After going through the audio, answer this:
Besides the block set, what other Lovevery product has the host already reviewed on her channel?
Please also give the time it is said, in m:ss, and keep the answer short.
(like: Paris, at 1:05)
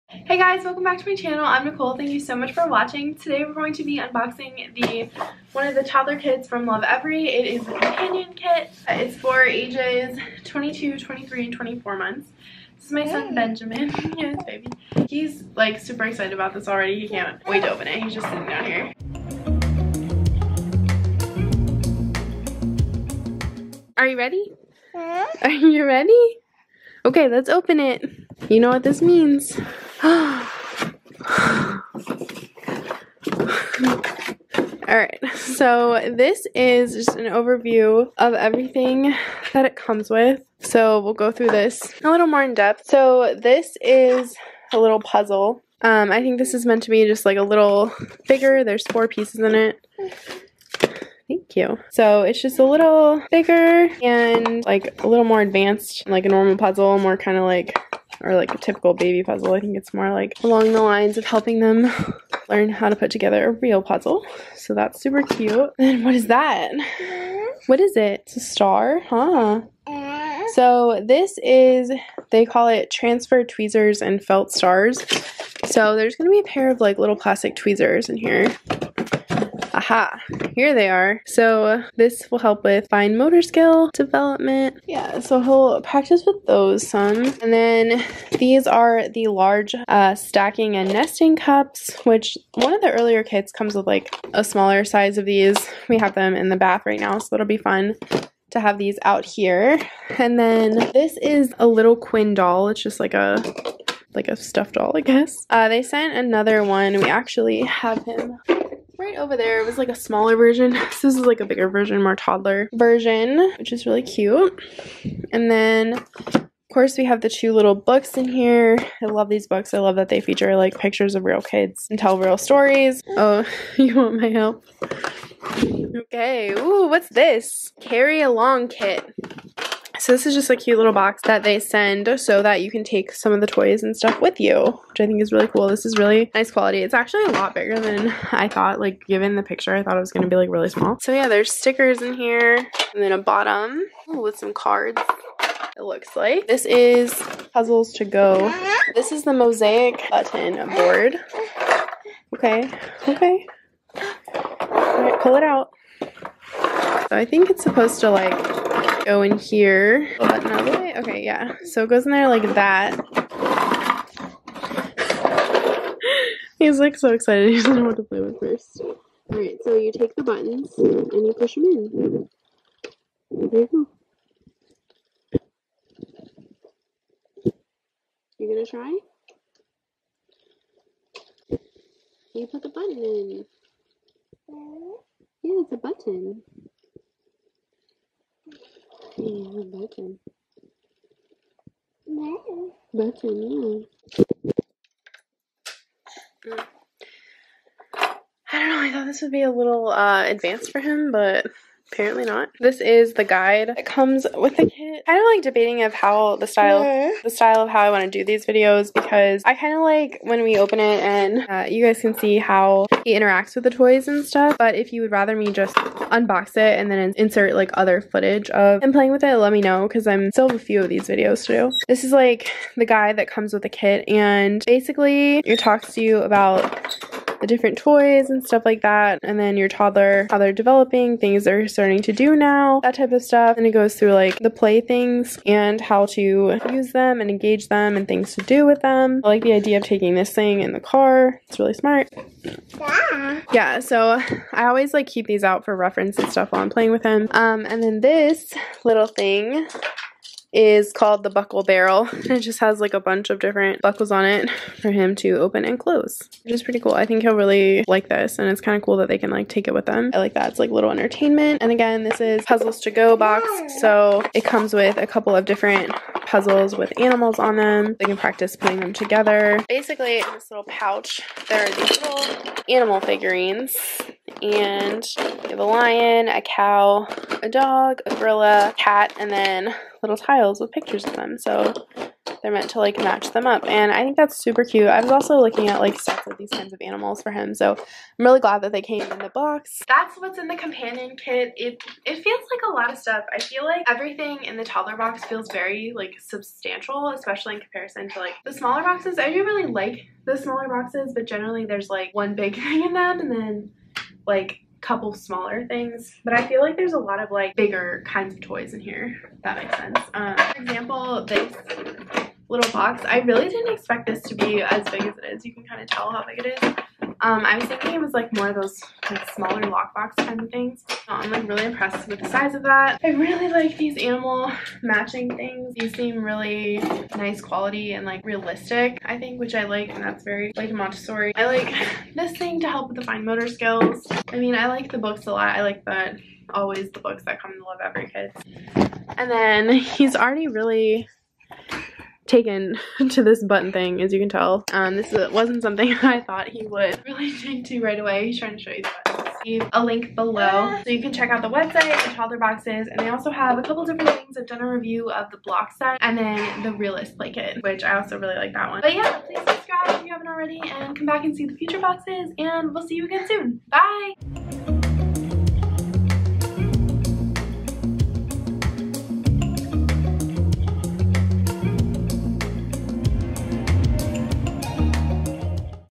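Realist blanket, at 5:56.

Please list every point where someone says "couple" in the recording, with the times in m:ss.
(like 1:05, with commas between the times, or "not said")
4:25, 5:04, 5:53.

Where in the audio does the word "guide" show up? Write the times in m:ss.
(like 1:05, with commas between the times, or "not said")
3:23, 3:42.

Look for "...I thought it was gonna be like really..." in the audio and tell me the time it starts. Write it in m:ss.
2:19.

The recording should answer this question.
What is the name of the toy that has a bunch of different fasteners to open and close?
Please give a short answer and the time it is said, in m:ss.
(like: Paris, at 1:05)
Buckle barrel, at 4:11.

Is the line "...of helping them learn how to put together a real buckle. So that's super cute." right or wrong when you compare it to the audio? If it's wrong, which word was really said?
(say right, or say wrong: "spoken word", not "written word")
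wrong: "puzzle", not "buckle".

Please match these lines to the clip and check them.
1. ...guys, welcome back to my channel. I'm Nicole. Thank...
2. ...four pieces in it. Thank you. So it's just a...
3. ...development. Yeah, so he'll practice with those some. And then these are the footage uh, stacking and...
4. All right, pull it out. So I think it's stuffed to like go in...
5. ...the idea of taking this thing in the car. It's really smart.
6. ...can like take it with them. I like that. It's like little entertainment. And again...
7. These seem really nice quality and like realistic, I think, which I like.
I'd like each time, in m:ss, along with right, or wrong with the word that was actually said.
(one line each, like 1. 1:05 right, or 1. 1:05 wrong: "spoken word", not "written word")
1. 0:00 right
2. 0:48 right
3. 1:23 wrong: "large", not "footage"
4. 2:34 wrong: "supposed", not "stuffed"
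5. 3:59 right
6. 4:19 right
7. 5:25 right.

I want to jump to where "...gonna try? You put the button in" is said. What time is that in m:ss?
2:58.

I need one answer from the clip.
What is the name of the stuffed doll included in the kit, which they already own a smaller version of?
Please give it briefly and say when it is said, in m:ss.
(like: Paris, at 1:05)
Quinn, at 1:41.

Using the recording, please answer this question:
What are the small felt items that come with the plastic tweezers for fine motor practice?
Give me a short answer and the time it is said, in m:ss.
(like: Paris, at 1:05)
Stars, at 1:14.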